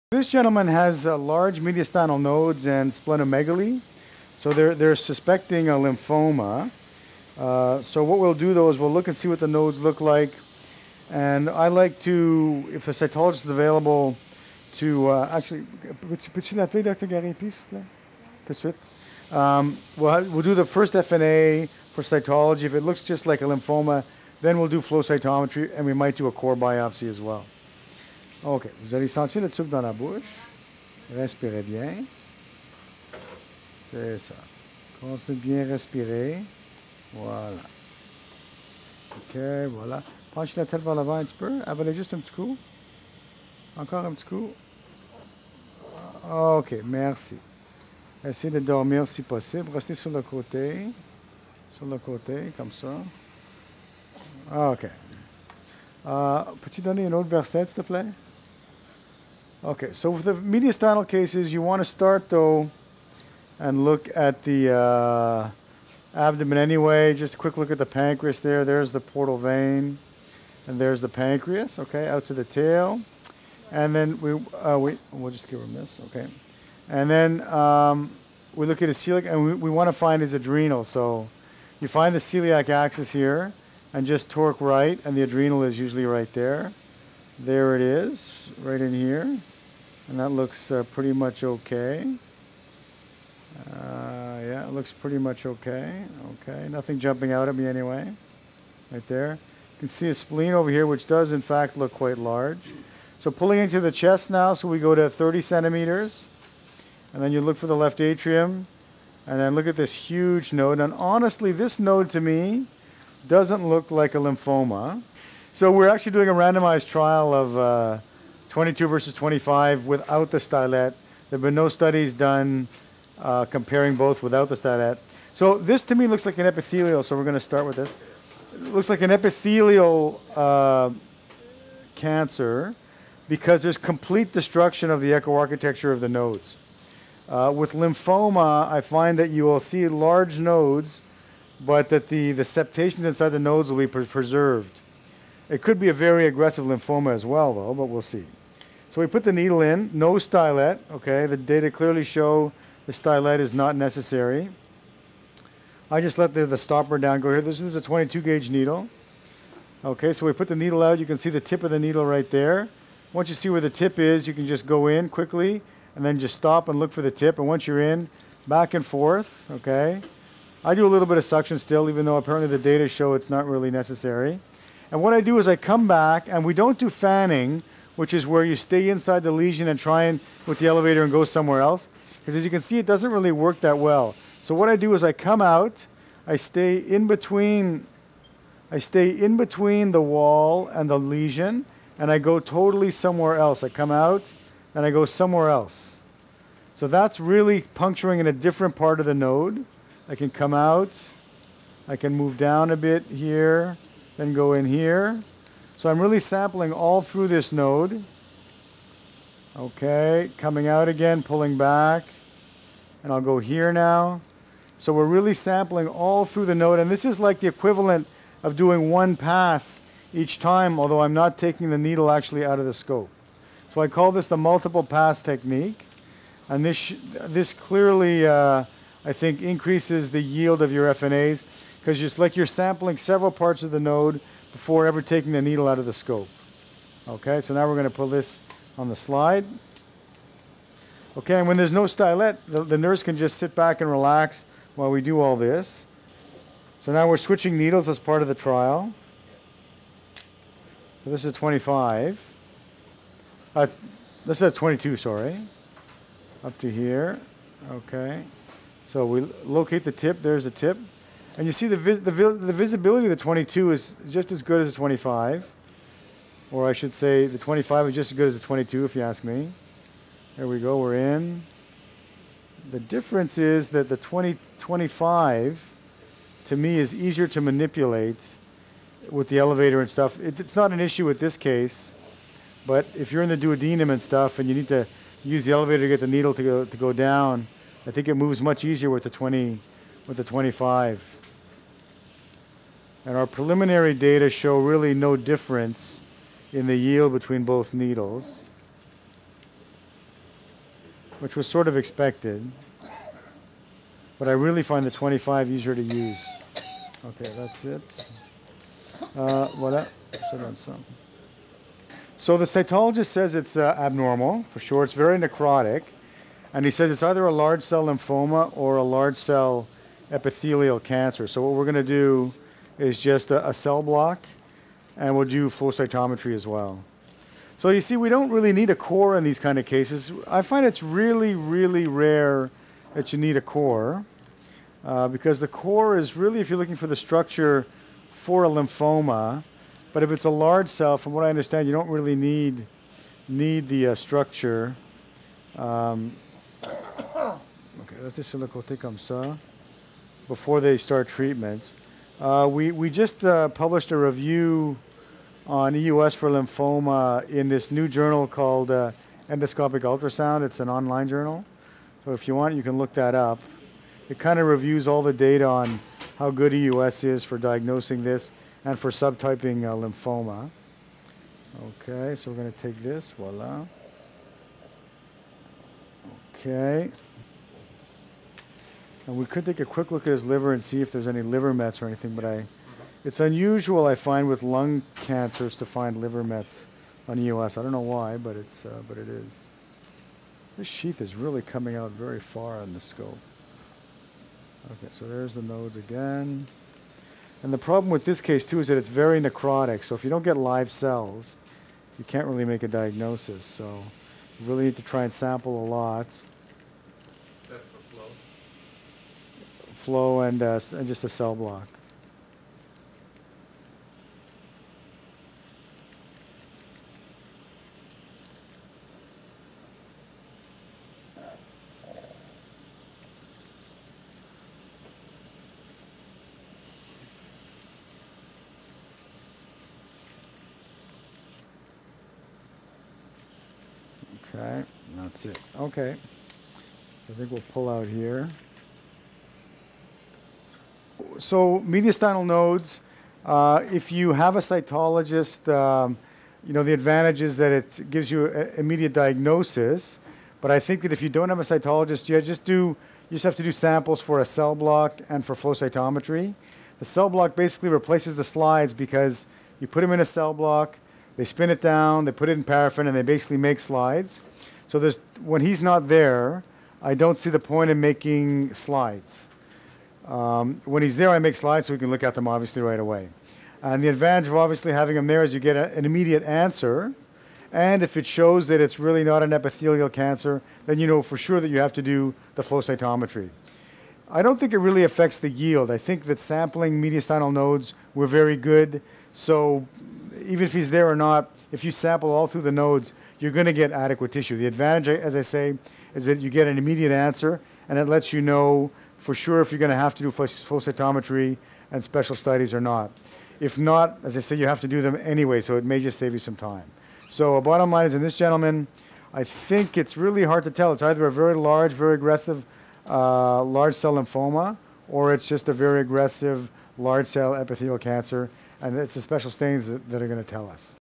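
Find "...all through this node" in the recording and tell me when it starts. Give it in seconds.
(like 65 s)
206 s.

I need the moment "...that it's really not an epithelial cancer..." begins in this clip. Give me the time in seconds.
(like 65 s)
478 s.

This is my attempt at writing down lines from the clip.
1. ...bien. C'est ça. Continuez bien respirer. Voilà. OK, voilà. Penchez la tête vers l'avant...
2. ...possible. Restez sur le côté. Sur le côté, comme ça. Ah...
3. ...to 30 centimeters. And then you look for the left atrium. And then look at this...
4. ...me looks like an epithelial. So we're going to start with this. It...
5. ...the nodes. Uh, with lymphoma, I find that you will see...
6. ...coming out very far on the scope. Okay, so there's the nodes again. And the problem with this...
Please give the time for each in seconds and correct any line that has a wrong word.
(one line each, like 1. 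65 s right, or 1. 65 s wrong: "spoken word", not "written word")
1. 31 s right
2. 49 s right
3. 104 s right
4. 125 s right
5. 136 s right
6. 391 s right.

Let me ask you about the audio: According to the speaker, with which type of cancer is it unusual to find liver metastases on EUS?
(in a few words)
lung cancers.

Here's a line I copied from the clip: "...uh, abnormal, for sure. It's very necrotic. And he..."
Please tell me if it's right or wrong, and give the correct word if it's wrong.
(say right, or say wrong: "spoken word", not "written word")
right.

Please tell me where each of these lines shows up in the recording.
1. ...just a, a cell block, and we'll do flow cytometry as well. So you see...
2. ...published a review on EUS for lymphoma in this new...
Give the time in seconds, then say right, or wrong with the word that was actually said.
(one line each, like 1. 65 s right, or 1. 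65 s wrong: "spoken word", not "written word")
1. 322 s right
2. 353 s right.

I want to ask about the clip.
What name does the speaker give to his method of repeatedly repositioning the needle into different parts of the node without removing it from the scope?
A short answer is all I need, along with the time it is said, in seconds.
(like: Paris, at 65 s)
multiple pass technique, at 224 s.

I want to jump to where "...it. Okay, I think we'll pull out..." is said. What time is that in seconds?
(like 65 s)
435 s.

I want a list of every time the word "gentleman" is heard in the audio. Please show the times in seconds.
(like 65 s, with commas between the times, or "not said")
0 s, 508 s.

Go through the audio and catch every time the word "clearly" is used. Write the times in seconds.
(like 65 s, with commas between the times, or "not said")
151 s, 227 s.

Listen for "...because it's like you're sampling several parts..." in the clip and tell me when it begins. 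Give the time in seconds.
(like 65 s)
231 s.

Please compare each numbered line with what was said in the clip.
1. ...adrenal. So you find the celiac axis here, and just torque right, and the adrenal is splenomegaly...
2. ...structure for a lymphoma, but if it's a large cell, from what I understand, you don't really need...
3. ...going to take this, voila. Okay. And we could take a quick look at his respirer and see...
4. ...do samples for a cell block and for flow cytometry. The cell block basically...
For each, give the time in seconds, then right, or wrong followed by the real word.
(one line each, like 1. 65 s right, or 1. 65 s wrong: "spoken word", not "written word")
1. 80 s wrong: "usually", not "splenomegaly"
2. 336 s right
3. 372 s wrong: "liver", not "respirer"
4. 453 s right.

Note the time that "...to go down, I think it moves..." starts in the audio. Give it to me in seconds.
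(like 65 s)
286 s.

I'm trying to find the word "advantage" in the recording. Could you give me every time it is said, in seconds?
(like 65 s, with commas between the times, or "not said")
446 s, 473 s, 494 s.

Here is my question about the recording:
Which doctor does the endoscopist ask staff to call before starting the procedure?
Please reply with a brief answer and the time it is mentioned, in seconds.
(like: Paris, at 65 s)
Dr. Gary, at 16 s.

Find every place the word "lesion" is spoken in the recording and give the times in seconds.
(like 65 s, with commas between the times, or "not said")
179 s, 190 s.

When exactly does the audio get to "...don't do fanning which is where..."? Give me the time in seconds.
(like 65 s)
176 s.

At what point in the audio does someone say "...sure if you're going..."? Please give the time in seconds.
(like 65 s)
499 s.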